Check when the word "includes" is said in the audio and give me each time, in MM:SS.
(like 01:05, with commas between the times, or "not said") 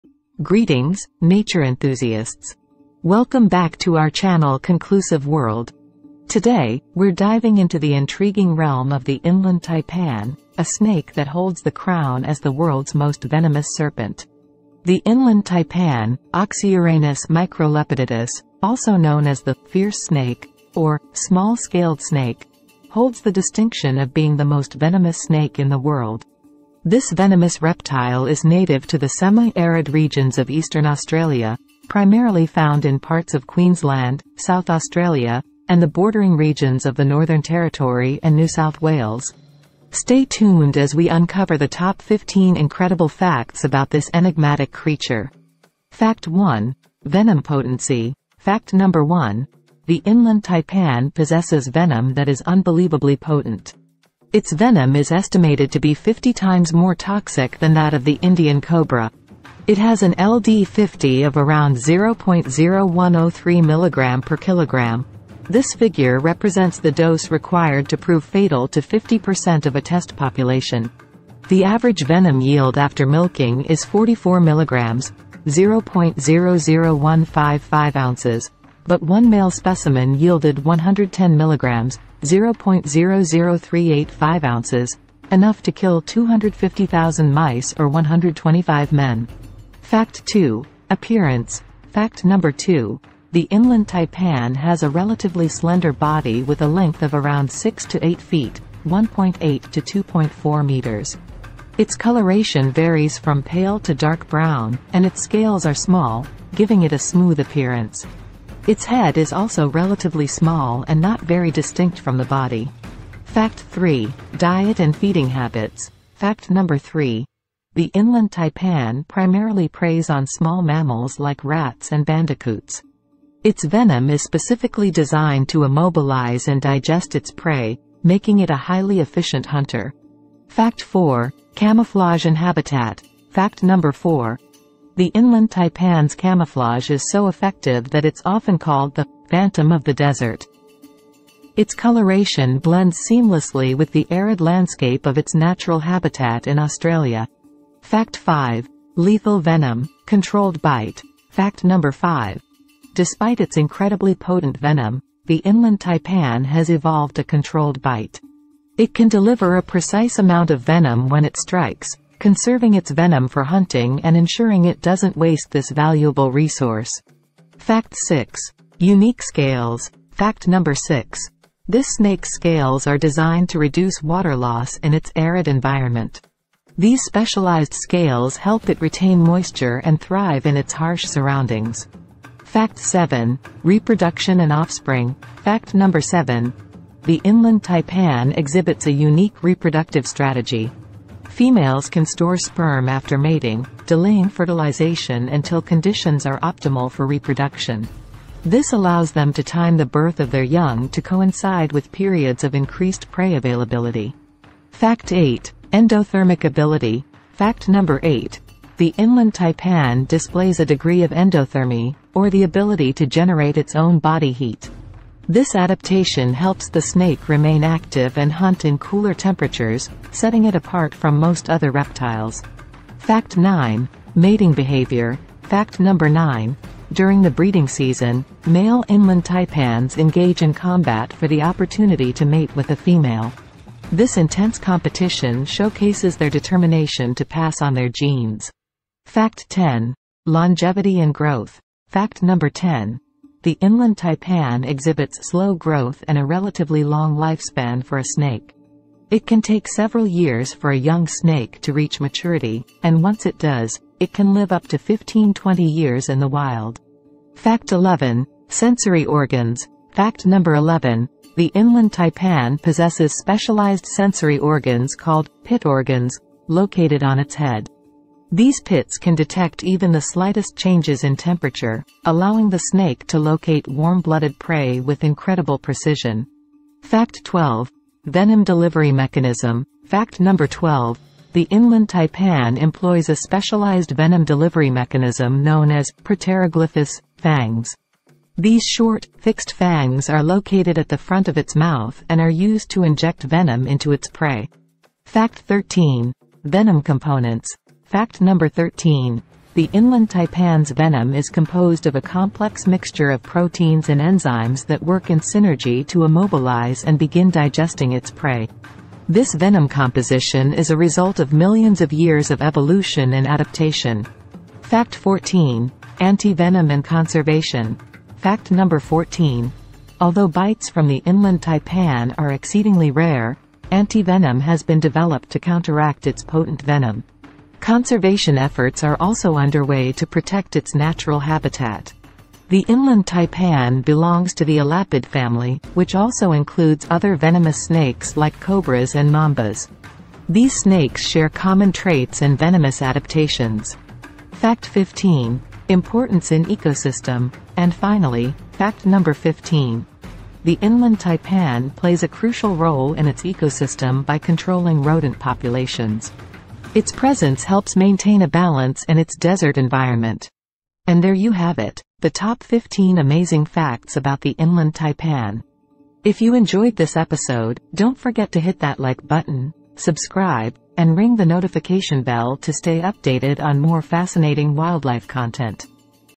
05:36.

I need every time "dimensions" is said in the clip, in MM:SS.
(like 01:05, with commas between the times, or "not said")
not said.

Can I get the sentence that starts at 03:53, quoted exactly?
This intense competition showcases their determination to pass on their genes.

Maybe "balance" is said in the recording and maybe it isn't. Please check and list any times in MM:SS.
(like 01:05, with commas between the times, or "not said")
05:58.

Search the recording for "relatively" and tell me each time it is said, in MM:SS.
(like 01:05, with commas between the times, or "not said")
01:34, 01:49, 04:06.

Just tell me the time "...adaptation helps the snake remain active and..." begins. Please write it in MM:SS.
03:35.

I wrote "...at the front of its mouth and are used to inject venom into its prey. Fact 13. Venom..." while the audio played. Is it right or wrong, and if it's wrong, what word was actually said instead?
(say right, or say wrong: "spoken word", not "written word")
right.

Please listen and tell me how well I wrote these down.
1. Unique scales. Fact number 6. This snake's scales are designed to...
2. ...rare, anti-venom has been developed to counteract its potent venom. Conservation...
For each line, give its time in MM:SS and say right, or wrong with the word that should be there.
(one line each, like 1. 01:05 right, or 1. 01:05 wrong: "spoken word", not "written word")
1. 02:48 right
2. 05:22 right.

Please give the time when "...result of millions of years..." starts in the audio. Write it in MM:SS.
05:10.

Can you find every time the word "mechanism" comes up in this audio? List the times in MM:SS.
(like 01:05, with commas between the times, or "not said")
04:38, 04:44.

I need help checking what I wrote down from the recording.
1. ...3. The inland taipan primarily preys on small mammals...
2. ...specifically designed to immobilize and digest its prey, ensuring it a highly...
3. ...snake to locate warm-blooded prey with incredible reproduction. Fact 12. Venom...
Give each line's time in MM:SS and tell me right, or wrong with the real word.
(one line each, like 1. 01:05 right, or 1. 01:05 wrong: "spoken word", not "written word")
1. 01:56 right
2. 02:04 wrong: "making", not "ensuring"
3. 04:32 wrong: "precision", not "reproduction".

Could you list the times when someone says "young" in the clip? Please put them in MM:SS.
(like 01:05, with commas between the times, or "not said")
03:20, 04:10.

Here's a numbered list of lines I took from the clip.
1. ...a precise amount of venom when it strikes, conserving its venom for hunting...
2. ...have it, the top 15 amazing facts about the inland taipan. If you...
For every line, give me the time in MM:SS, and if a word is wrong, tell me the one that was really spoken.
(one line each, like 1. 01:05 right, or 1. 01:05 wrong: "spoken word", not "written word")
1. 02:39 right
2. 06:01 right.